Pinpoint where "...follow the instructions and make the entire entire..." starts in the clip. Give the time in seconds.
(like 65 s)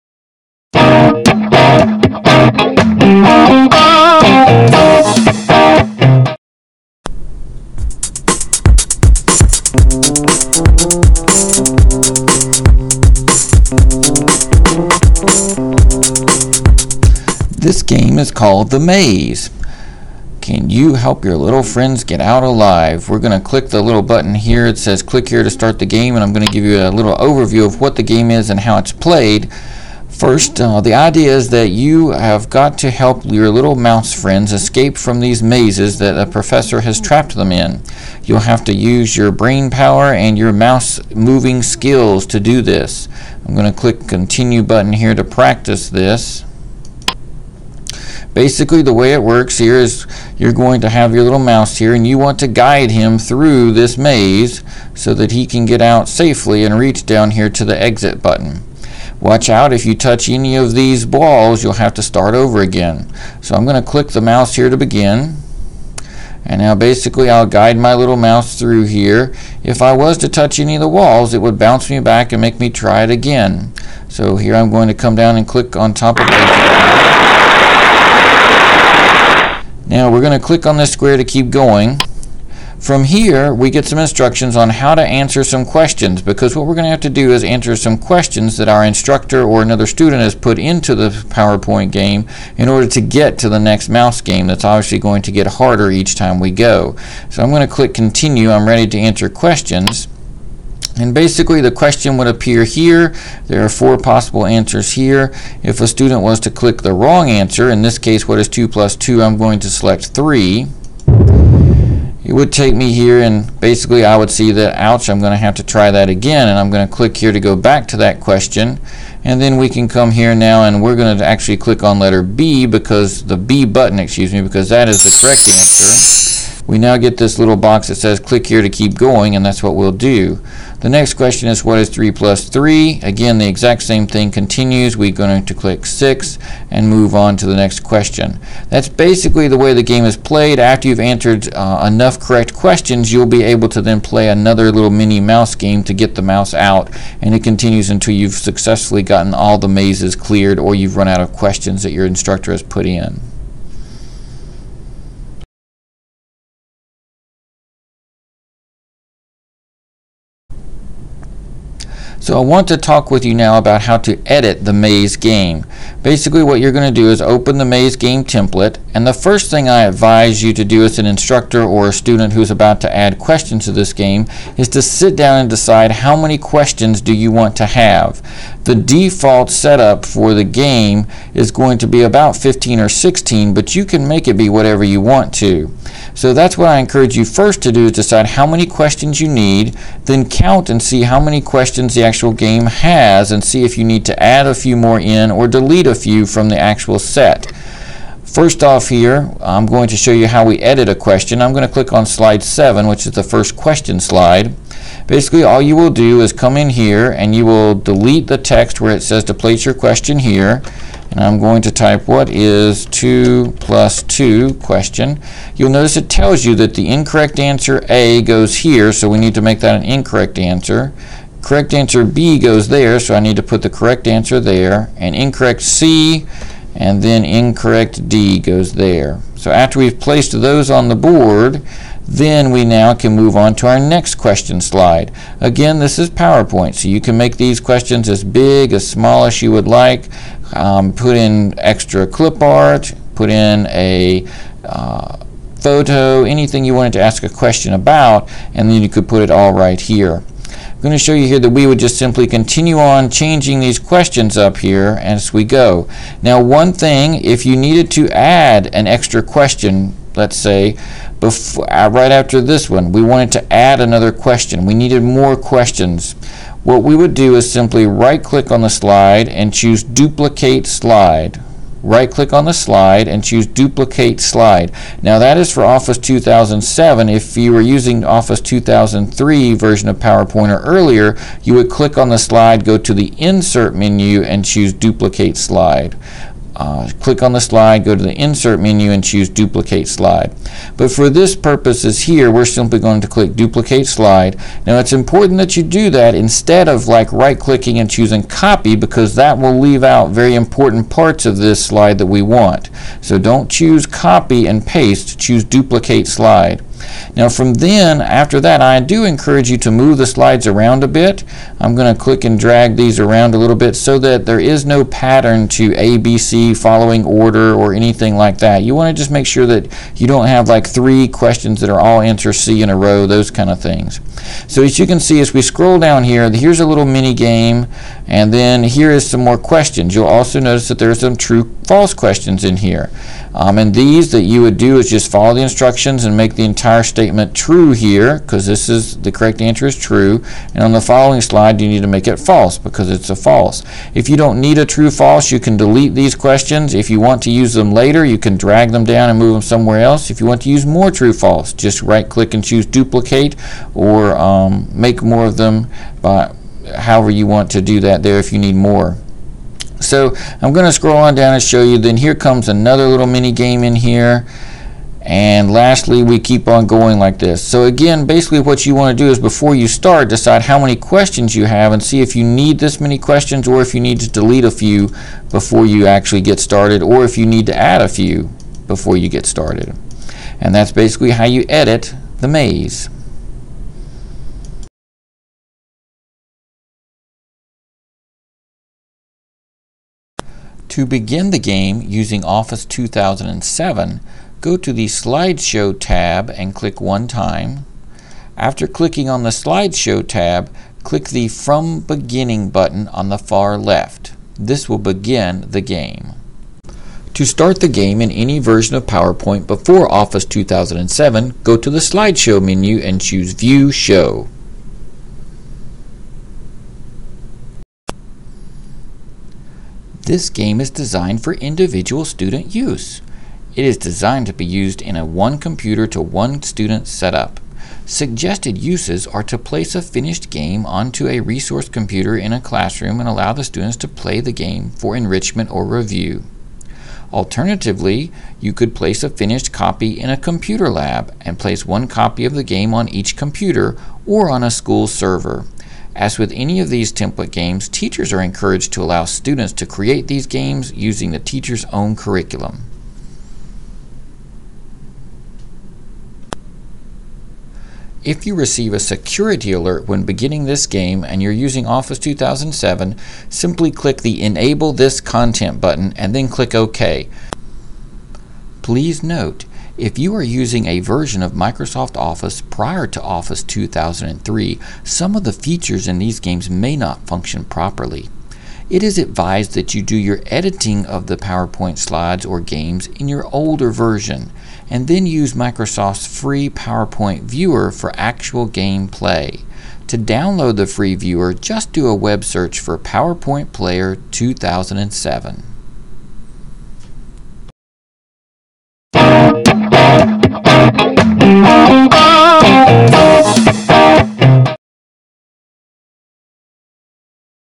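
335 s.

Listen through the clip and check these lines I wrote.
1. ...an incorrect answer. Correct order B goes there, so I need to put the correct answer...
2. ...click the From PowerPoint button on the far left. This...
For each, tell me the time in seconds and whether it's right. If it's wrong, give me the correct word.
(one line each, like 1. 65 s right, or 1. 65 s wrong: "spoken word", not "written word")
1. 219 s wrong: "answer", not "order"
2. 400 s wrong: "Beginning", not "PowerPoint".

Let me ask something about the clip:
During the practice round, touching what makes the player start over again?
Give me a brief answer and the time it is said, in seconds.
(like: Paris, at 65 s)
Balls, at 61 s.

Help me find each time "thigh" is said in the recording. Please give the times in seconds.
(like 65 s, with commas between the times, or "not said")
not said.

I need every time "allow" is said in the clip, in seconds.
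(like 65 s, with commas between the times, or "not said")
433 s, 448 s.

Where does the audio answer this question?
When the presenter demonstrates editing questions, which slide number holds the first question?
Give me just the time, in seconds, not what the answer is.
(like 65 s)
202 s.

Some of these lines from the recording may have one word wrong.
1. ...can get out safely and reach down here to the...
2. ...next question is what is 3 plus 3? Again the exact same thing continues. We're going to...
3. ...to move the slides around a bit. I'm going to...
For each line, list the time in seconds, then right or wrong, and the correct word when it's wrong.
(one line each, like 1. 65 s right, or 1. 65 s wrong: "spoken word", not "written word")
1. 55 s right
2. 130 s right
3. 309 s right.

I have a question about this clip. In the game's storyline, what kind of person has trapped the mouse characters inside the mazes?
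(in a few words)
A professor.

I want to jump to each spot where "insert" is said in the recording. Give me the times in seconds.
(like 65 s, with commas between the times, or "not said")
283 s, 288 s.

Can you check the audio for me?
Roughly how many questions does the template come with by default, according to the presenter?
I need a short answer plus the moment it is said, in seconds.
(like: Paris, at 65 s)
15 or 16, at 182 s.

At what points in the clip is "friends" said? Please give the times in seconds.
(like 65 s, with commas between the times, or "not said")
21 s, 34 s.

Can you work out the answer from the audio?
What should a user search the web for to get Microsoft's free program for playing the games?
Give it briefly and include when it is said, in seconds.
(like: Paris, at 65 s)
PowerPoint Player 2007, at 492 s.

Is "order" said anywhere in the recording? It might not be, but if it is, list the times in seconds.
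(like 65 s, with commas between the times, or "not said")
92 s, 317 s.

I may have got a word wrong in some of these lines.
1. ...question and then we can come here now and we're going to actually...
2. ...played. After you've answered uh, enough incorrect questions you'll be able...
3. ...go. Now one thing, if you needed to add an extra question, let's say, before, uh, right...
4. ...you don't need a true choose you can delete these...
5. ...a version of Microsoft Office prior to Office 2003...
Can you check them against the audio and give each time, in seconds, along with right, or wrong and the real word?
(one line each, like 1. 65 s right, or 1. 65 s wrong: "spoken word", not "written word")
1. 118 s right
2. 140 s wrong: "correct", not "incorrect"
3. 255 s right
4. 344 s wrong: "false", not "choose"
5. 470 s right.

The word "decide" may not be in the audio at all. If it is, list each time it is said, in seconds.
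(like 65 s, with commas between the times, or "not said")
175 s, 187 s, 370 s.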